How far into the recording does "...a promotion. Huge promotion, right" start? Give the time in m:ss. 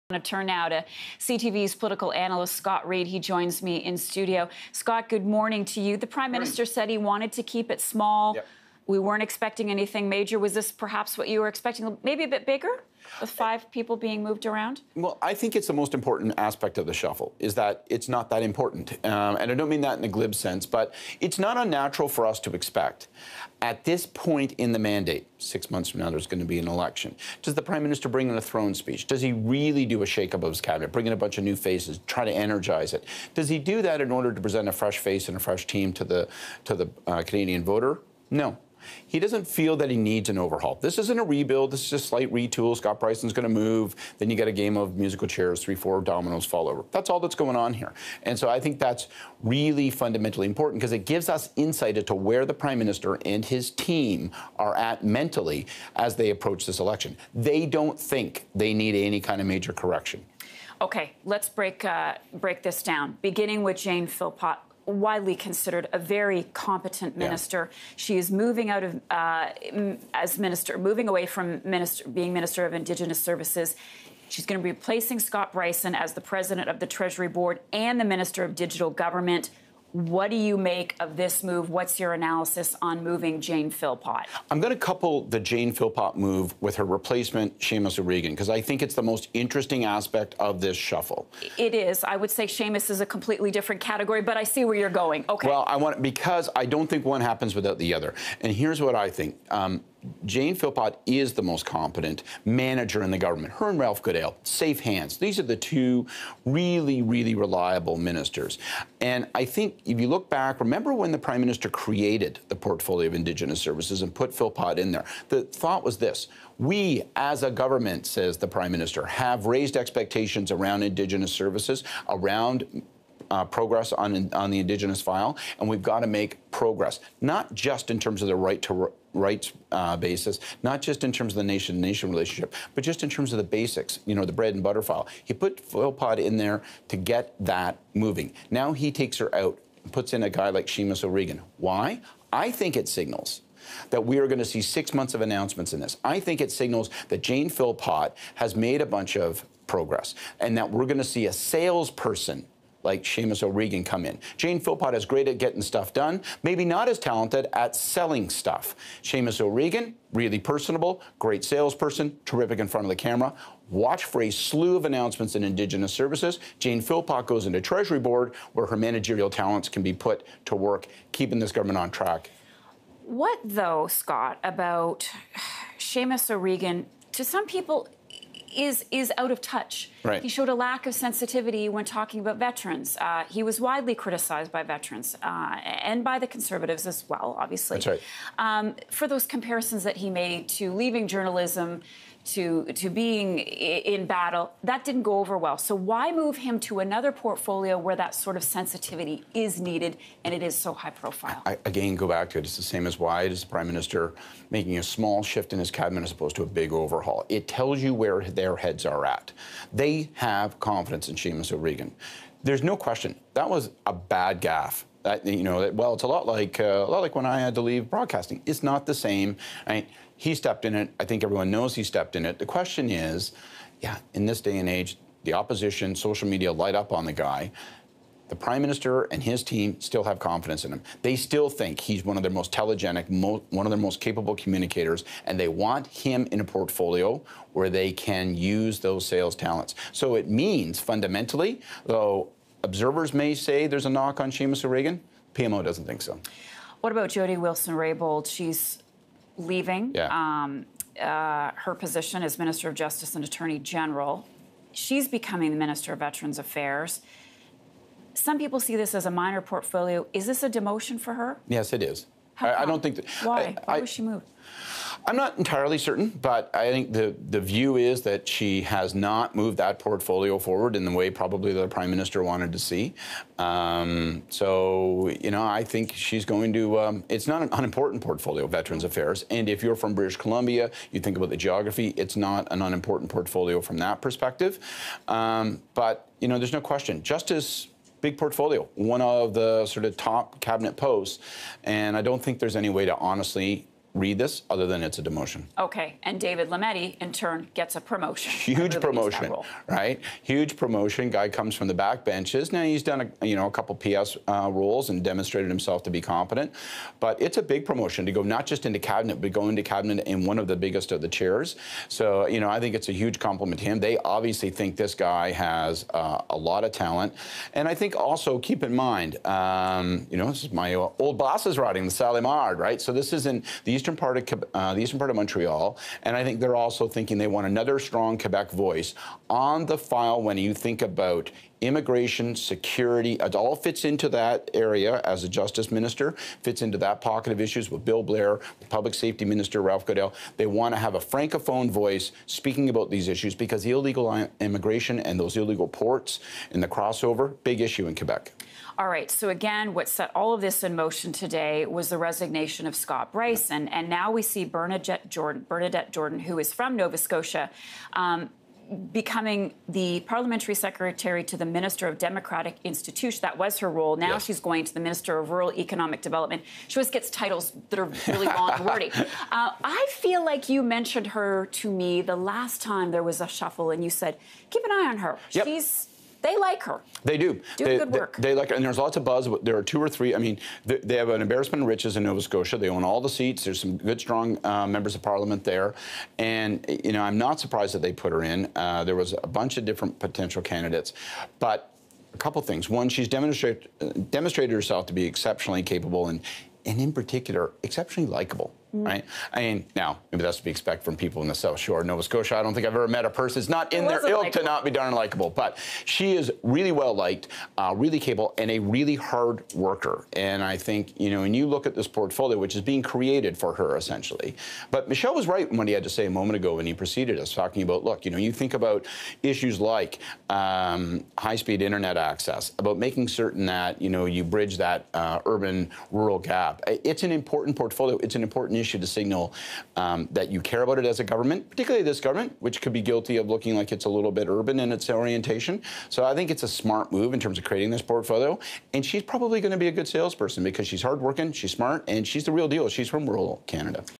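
4:57.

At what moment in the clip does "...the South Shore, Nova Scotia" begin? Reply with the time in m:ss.
6:41.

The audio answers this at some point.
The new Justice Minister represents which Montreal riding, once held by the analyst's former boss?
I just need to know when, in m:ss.
5:21.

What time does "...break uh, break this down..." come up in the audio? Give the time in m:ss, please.
1:01.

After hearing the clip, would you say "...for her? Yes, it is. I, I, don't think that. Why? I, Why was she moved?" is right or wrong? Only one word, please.
right.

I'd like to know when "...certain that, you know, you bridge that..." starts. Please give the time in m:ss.
7:03.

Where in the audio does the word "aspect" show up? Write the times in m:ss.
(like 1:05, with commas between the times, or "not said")
0:16, 1:29.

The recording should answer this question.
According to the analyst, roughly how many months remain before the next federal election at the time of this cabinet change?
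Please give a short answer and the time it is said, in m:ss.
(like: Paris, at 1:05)
6, at 0:25.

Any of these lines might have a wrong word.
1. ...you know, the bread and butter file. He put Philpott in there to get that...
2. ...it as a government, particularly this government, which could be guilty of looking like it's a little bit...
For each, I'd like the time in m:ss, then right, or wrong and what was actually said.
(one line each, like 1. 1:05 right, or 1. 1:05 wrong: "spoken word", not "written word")
1. 2:14 right
2. 7:10 right.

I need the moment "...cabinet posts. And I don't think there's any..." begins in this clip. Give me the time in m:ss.
4:50.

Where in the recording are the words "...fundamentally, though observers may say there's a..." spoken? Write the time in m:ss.
4:00.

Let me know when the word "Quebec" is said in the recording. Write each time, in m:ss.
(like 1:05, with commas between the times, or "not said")
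5:28, 5:47.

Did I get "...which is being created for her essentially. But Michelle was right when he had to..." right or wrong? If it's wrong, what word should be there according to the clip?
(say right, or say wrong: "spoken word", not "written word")
right.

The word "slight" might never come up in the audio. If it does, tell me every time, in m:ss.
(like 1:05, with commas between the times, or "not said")
0:41.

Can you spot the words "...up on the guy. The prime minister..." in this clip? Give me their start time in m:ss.
3:46.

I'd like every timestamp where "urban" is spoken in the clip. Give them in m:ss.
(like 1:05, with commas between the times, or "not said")
7:05, 7:14.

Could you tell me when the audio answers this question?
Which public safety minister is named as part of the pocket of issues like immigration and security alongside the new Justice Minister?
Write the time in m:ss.
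5:37.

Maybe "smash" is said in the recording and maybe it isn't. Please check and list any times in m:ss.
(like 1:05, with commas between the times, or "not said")
not said.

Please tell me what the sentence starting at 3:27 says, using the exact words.
It tells you where their heads are at.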